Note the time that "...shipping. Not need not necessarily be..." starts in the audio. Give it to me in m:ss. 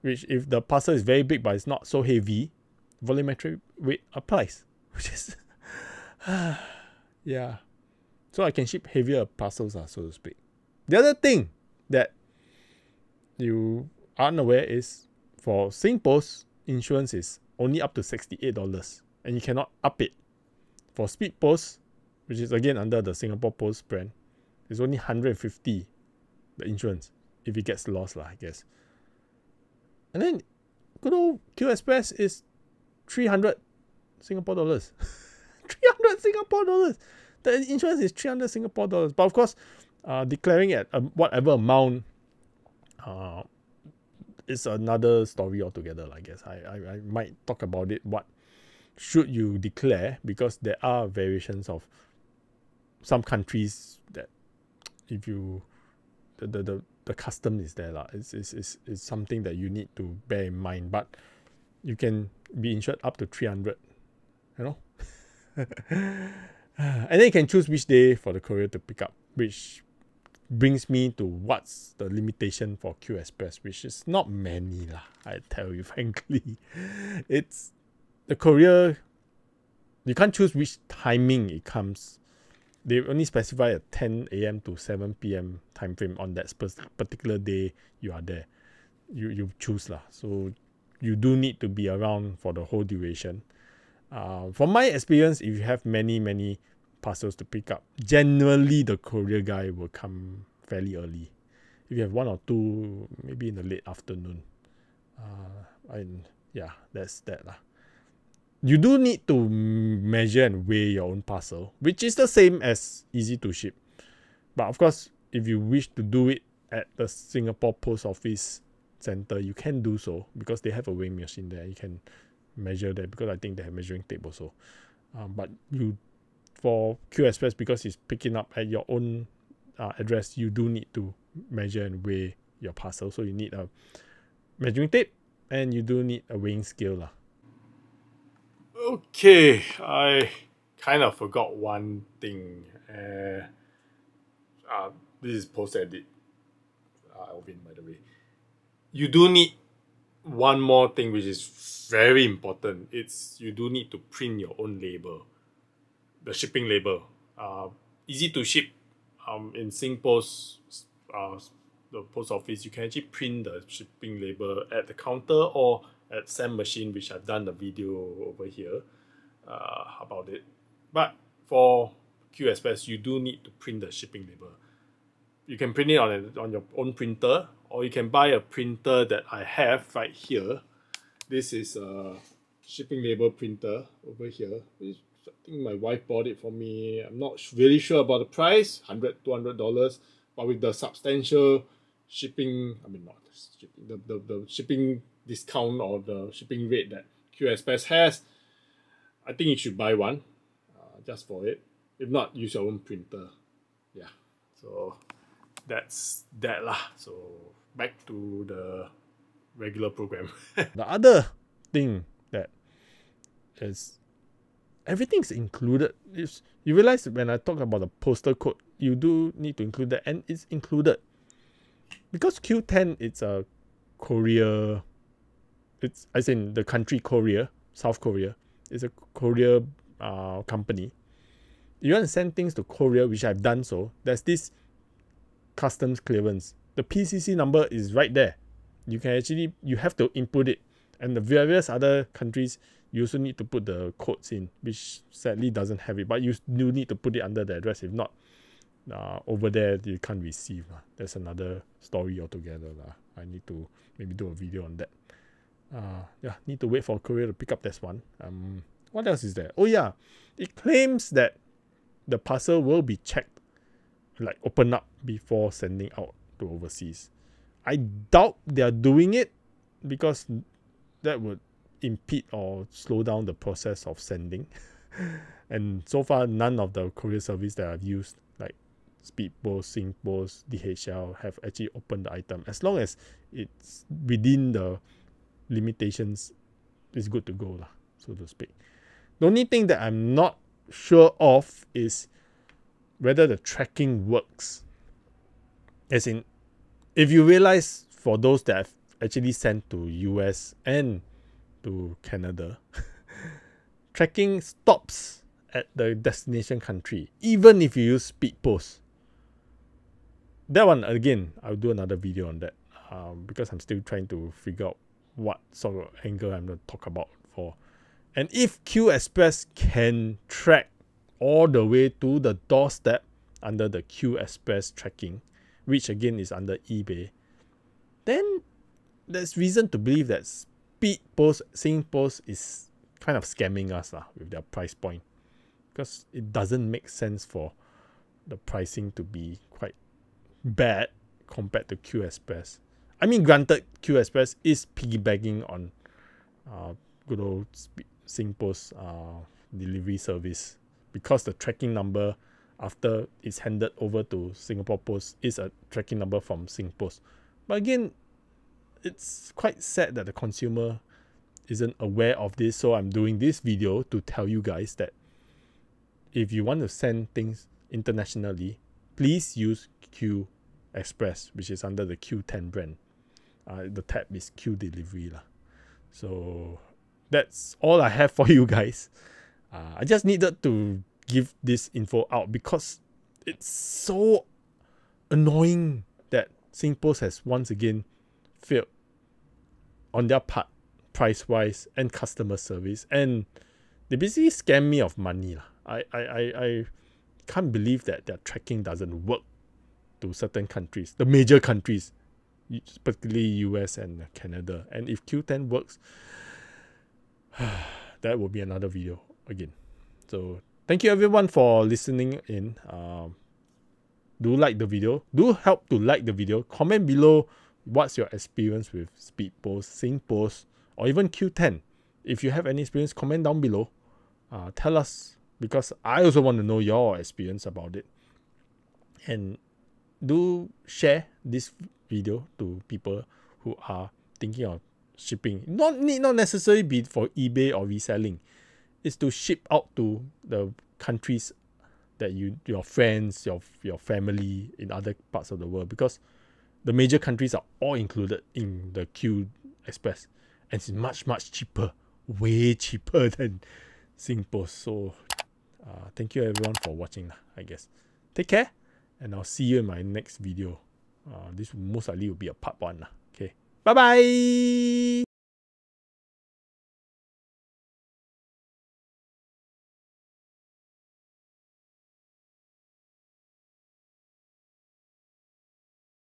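7:14.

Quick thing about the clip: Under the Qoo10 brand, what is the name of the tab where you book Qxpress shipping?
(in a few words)
Q delivery.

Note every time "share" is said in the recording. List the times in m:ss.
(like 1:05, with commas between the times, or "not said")
7:10.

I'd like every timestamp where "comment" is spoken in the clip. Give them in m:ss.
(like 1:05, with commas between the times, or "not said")
6:56, 7:02.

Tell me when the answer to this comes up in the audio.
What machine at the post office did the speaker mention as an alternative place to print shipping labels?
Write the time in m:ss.
2:46.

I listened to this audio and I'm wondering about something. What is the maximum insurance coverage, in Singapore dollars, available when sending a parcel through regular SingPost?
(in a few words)
$68.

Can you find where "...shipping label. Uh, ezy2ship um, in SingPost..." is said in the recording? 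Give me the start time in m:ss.
2:36.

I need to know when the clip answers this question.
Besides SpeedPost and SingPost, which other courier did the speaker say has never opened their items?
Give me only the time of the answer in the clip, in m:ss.
4:40.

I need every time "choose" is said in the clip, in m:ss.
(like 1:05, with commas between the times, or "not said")
1:07, 1:20, 1:29.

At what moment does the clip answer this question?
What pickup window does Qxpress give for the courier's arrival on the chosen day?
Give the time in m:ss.
1:23.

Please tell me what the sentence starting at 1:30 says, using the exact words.
So you do need to be around for the whole duration.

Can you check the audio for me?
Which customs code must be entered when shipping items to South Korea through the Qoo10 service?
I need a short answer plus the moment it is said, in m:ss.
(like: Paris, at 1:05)
PCC number, at 3:56.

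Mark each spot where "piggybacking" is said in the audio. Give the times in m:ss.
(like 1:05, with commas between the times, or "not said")
5:44.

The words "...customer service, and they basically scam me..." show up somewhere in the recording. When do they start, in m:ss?
6:31.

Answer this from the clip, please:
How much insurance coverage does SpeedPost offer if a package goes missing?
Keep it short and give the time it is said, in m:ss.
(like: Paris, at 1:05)
150, at 0:24.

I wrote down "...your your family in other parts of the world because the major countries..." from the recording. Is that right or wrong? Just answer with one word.
right.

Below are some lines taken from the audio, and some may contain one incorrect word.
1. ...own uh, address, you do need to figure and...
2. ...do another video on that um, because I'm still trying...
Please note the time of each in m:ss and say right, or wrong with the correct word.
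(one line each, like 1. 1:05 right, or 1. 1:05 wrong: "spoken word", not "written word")
1. 2:08 wrong: "measure", not "figure"
2. 5:11 right.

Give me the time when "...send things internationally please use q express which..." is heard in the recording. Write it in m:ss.
6:06.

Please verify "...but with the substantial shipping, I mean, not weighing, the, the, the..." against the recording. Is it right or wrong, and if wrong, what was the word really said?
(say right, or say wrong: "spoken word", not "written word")
wrong: "shipping", not "weighing".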